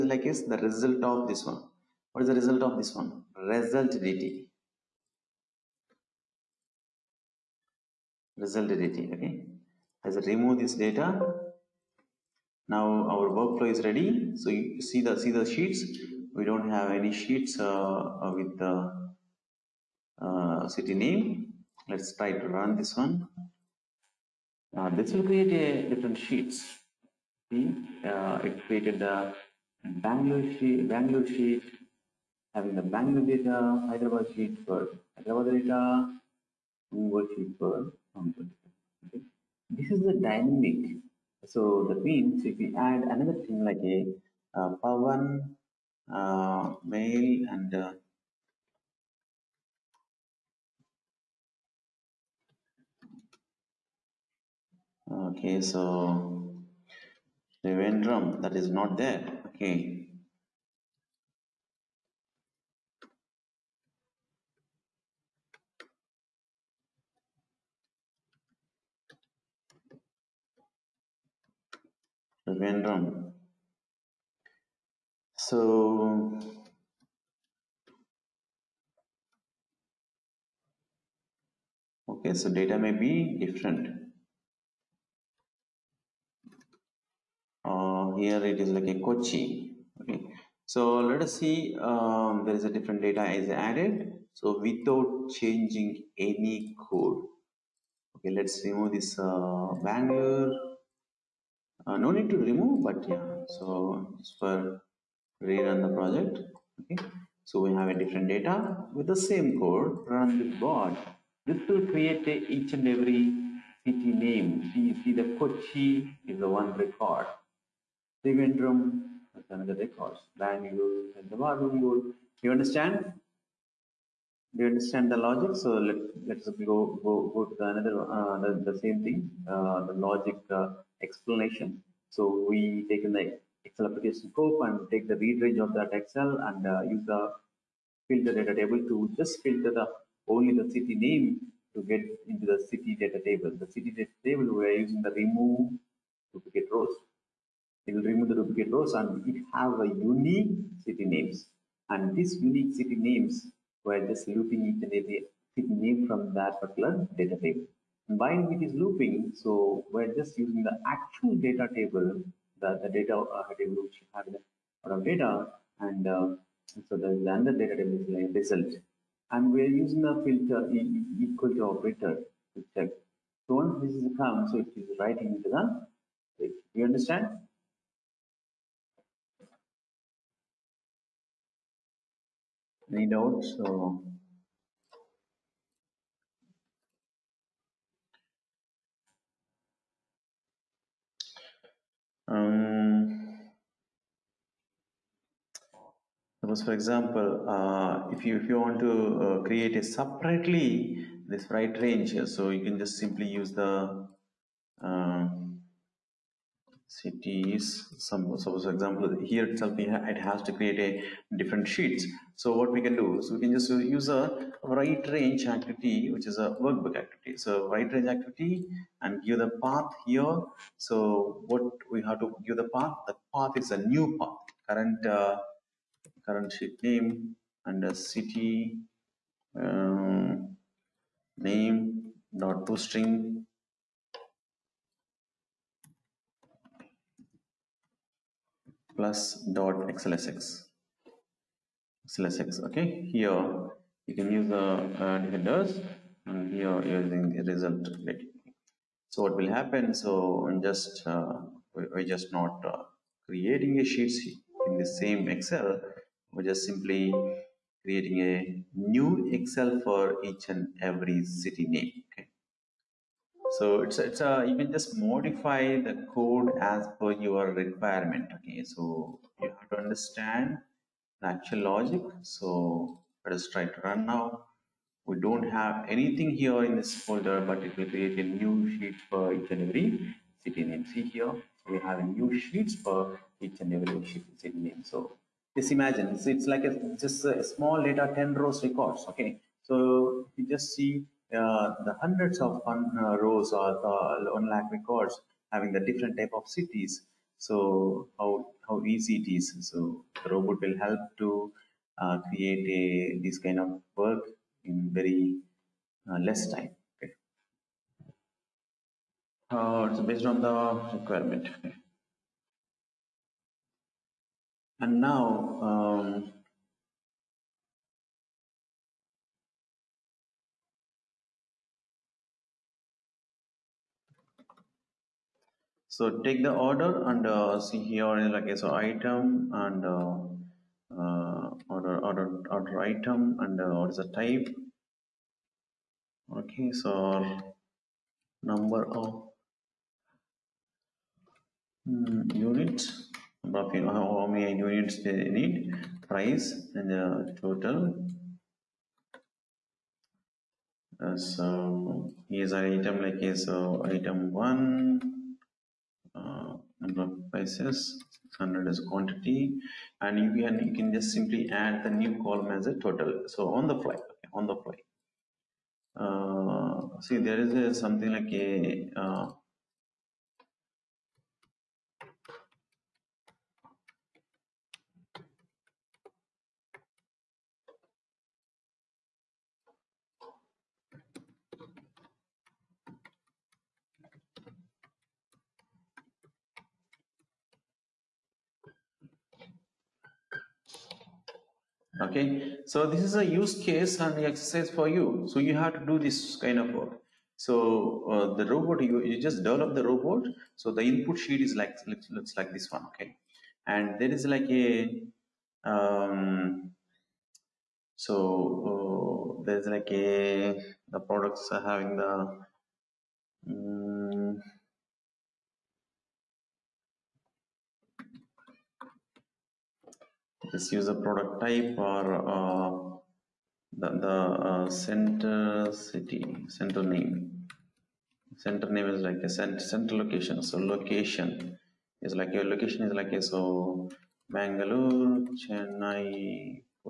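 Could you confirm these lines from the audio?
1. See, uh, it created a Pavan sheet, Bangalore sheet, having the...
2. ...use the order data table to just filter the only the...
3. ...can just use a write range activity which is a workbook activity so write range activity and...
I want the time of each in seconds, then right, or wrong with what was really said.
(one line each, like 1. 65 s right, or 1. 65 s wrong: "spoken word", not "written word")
1. 27 s wrong: "Bangalore", not "Pavan"
2. 136 s wrong: "filter", not "order"
3. 213 s right.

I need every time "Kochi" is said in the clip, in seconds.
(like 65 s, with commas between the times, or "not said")
88 s, 115 s.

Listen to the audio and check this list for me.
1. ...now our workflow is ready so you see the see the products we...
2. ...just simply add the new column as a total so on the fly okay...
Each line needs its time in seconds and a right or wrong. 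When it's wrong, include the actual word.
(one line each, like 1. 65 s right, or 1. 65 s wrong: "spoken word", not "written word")
1. 12 s wrong: "sheets", not "products"
2. 360 s right.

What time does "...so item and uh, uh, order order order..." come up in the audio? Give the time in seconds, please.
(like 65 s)
328 s.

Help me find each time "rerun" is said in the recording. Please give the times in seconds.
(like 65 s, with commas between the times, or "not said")
105 s.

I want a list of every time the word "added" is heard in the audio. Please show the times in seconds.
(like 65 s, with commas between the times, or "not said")
93 s.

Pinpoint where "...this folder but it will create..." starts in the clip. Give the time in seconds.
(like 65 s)
276 s.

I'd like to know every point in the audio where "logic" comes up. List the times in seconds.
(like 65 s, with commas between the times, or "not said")
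125 s, 129 s, 271 s.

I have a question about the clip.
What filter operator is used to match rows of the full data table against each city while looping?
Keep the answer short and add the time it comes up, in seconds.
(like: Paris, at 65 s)
equal to, at 171 s.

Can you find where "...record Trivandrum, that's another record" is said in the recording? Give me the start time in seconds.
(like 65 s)
116 s.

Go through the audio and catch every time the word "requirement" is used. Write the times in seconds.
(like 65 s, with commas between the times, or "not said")
267 s, 310 s.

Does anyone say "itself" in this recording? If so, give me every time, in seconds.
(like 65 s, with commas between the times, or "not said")
209 s.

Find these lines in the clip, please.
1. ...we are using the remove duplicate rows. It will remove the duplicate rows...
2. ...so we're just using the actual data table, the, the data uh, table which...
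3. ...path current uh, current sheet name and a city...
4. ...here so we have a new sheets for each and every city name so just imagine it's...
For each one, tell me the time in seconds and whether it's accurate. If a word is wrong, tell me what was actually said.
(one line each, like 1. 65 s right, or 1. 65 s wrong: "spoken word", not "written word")
1. 144 s right
2. 159 s right
3. 224 s right
4. 281 s right.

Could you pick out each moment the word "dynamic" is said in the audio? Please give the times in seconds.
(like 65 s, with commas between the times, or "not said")
40 s.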